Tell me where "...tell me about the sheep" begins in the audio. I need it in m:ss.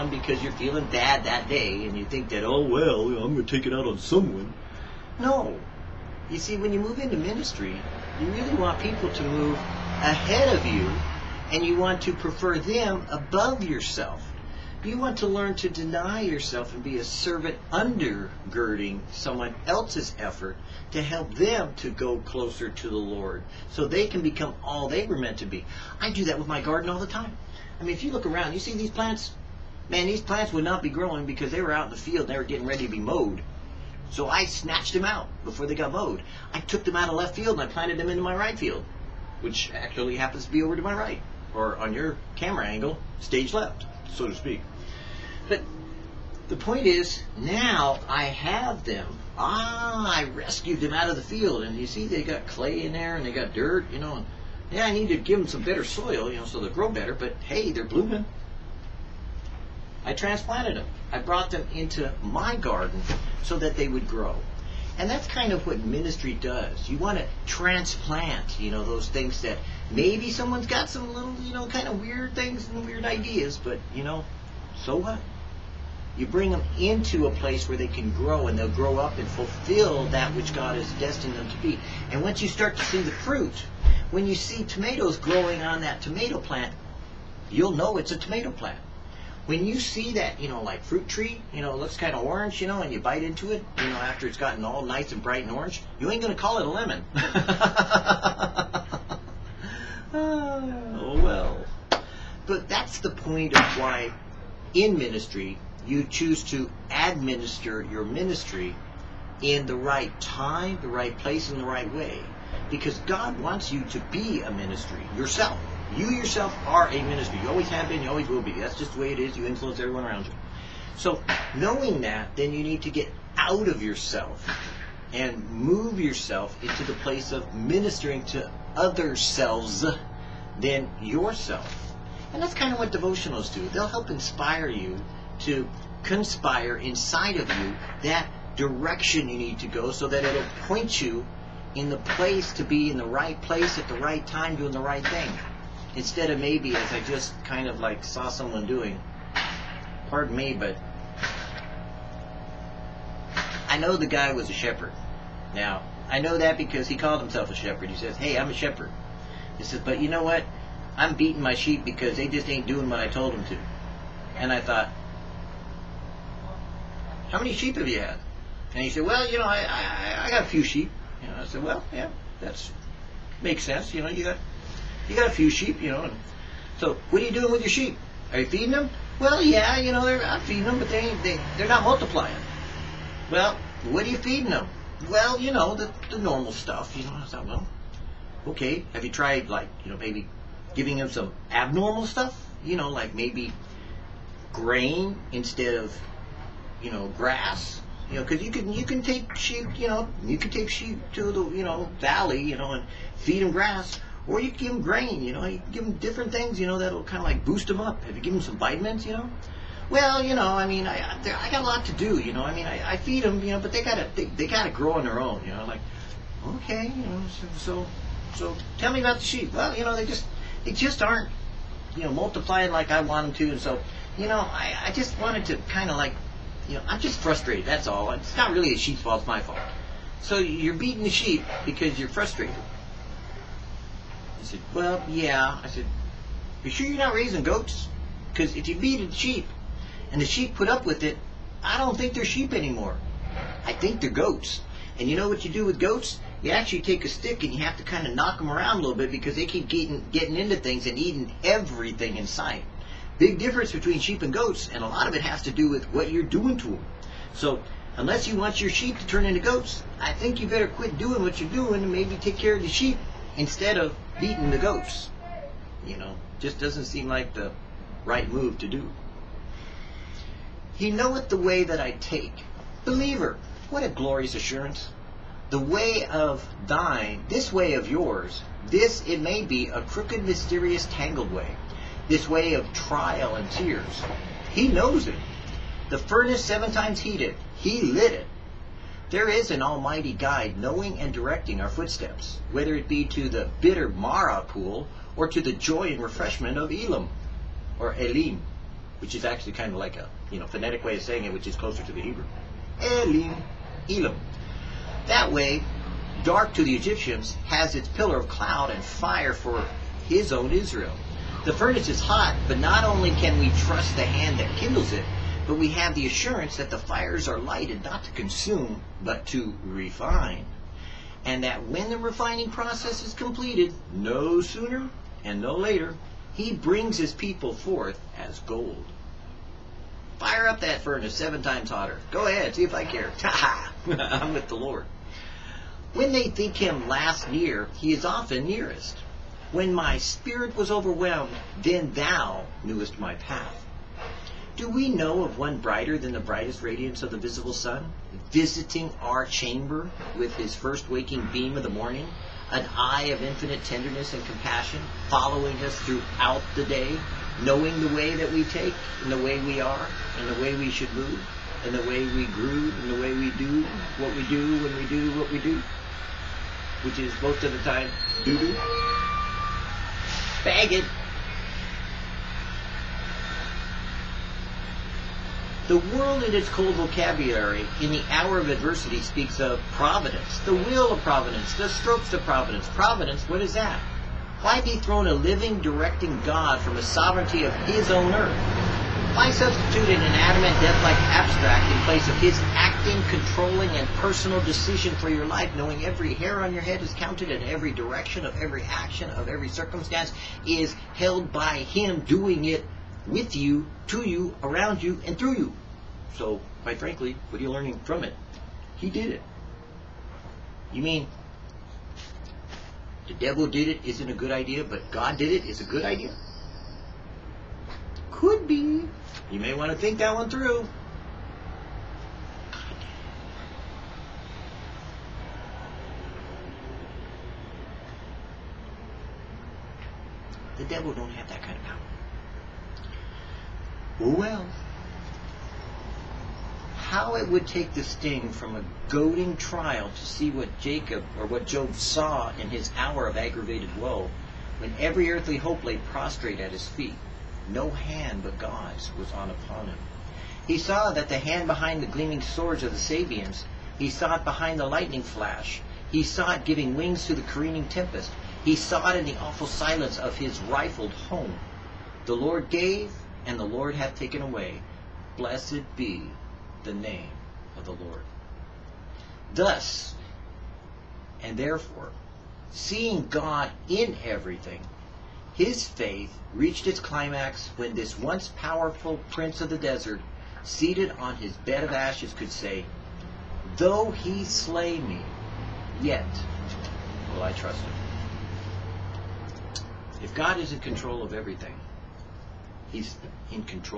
3:38.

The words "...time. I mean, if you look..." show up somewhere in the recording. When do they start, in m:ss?
0:27.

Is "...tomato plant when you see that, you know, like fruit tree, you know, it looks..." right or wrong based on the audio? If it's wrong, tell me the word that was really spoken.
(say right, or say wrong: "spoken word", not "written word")
right.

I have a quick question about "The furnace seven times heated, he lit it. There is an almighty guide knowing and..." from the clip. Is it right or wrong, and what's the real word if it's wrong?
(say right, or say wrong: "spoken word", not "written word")
right.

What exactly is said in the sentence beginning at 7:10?
The devil don't have that kind of power.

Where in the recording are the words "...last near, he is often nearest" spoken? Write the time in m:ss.
5:36.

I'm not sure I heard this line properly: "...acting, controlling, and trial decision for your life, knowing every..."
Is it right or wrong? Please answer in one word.
wrong.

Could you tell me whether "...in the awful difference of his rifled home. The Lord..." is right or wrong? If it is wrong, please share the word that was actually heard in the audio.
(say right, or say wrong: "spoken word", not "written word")
wrong: "silence", not "difference".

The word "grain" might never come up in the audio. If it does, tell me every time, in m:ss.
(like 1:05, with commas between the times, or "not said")
3:14, 3:24.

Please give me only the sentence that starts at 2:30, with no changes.
Pardon me, but I know the guy was a shepherd.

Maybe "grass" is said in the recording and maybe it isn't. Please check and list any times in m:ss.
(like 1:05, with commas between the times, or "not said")
3:17, 3:23.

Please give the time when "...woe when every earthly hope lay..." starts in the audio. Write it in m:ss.
7:23.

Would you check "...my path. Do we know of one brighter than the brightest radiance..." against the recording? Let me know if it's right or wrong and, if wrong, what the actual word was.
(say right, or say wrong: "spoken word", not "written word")
right.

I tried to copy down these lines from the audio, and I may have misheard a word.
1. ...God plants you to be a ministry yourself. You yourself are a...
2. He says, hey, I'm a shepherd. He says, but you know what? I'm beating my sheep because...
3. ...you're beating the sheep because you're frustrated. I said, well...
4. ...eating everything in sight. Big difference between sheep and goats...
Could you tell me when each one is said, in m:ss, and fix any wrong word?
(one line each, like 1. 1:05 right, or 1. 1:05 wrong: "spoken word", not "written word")
1. 1:52 wrong: "wants", not "plants"
2. 2:37 right
3. 3:50 right
4. 4:10 right.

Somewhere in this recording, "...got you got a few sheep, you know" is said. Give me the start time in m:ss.
2:54.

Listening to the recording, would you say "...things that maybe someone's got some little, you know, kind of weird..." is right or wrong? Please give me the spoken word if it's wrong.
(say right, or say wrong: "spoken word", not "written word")
right.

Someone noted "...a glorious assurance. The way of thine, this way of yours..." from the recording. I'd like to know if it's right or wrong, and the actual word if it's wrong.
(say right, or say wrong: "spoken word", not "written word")
right.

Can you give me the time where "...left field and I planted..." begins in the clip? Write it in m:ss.
0:37.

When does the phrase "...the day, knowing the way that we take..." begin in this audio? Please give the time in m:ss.
5:56.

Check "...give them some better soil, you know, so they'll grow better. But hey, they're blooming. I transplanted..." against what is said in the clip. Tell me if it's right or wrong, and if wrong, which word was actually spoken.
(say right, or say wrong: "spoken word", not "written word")
right.